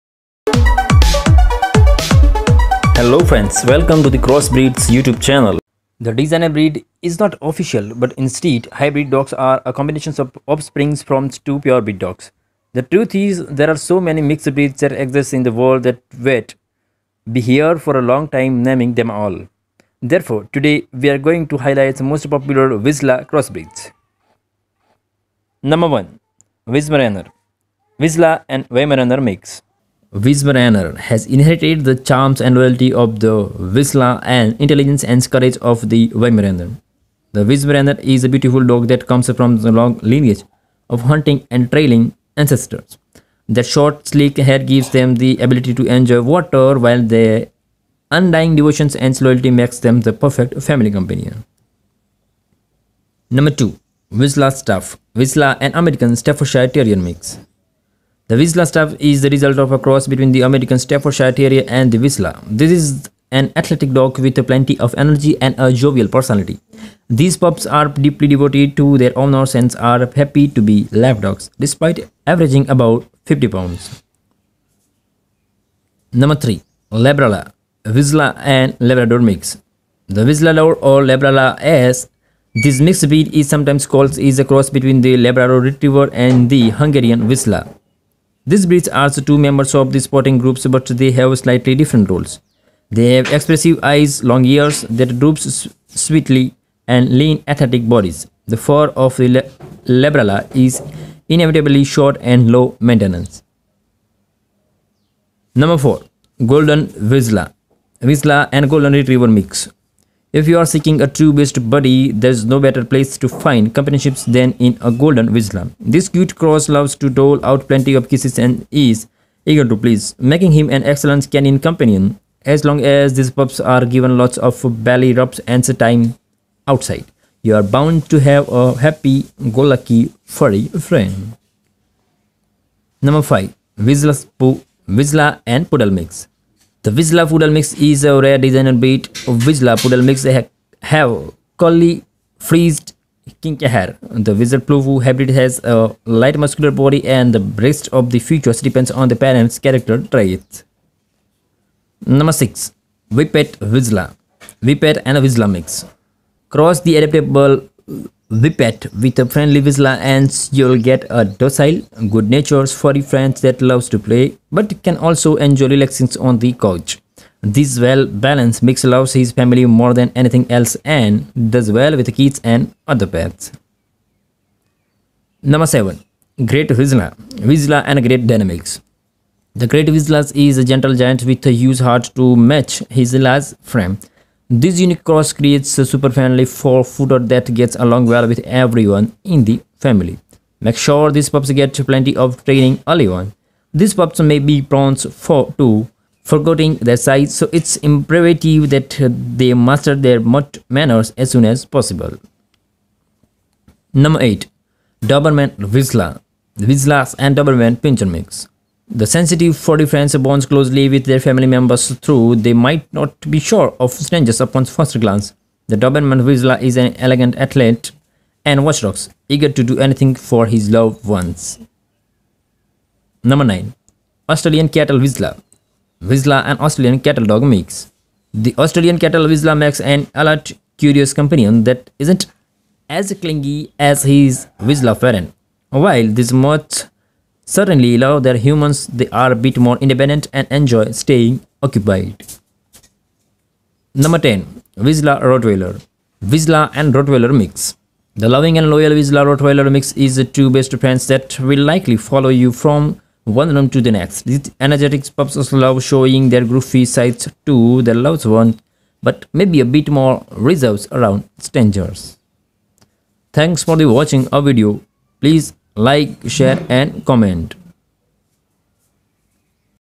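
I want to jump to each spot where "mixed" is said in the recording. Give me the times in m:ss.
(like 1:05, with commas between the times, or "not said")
0:14, 1:22.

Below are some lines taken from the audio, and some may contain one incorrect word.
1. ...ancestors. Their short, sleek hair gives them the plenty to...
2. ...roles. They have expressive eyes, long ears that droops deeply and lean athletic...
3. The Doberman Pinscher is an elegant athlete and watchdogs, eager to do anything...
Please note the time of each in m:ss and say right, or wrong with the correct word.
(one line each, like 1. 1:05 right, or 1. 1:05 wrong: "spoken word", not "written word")
1. 0:42 wrong: "ability", not "plenty"
2. 1:32 wrong: "sweetly", not "deeply"
3. 3:35 wrong: "Vizsla", not "Pinscher".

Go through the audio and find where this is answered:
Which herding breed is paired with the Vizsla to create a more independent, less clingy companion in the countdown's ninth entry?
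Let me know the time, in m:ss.
3:46.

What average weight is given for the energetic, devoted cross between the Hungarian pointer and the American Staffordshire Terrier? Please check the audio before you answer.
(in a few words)
50 pounds.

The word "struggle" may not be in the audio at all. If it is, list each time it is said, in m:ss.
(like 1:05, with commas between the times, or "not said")
not said.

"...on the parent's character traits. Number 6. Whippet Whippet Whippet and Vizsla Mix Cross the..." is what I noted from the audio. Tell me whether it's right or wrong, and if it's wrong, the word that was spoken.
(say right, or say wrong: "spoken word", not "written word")
wrong: "Vizsla", not "Whippet".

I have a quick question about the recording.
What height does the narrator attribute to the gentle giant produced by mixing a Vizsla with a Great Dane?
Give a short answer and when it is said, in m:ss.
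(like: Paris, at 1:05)
4 feet, at 3:06.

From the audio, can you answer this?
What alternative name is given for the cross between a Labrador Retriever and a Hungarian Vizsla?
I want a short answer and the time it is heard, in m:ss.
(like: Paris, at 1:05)
Whistler, at 1:20.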